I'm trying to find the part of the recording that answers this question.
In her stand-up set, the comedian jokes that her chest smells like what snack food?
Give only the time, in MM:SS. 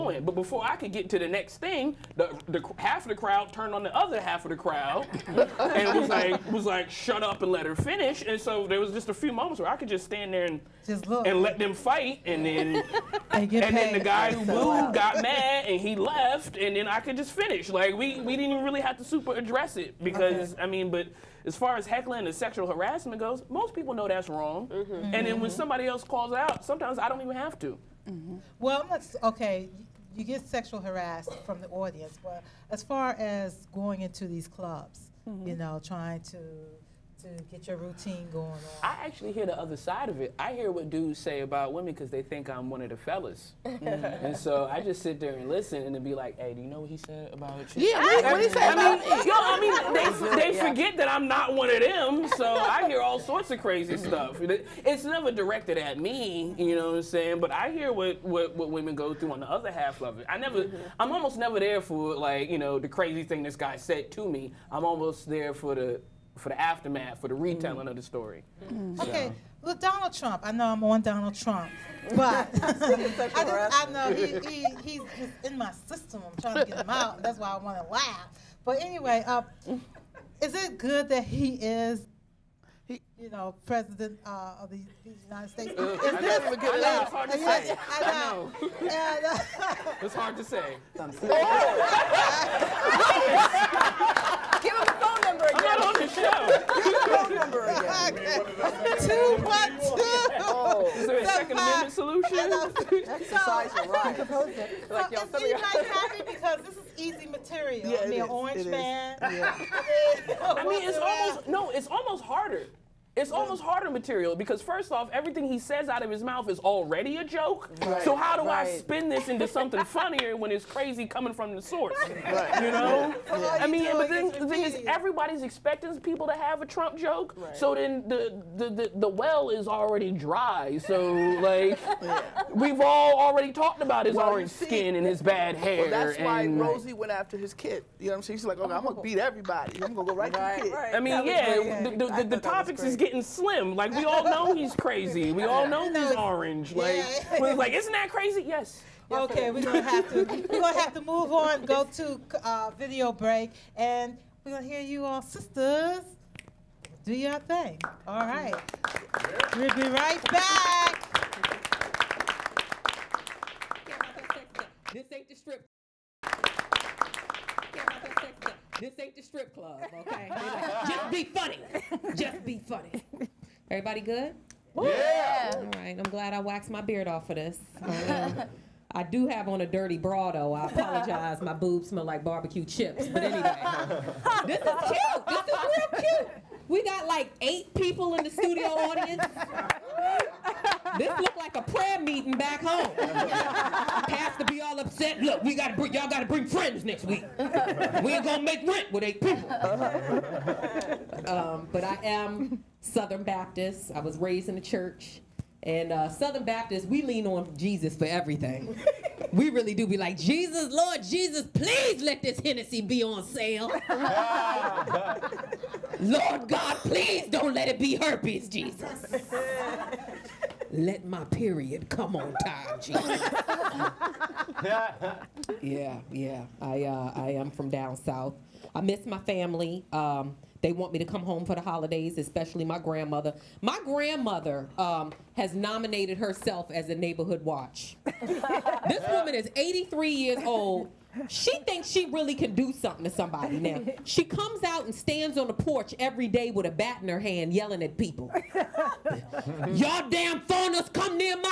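03:02.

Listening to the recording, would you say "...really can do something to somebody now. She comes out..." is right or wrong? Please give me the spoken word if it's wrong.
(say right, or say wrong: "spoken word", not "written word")
right.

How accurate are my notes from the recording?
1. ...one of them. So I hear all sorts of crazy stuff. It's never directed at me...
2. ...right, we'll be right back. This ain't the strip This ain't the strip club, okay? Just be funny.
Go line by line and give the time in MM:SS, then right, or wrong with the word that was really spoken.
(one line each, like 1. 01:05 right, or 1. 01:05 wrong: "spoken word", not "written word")
1. 00:51 right
2. 02:38 right.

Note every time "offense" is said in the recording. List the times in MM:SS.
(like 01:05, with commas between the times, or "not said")
not said.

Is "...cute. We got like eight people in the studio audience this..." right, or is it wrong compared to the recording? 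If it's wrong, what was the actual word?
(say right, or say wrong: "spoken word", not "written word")
right.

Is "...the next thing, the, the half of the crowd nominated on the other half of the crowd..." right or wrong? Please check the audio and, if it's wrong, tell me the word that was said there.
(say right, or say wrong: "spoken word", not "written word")
wrong: "turned", not "nominated".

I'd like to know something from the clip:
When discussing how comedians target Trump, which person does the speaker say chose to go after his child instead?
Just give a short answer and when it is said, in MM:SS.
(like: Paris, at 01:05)
Rosie, at 02:16.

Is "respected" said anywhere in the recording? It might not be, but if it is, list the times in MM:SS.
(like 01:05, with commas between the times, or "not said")
not said.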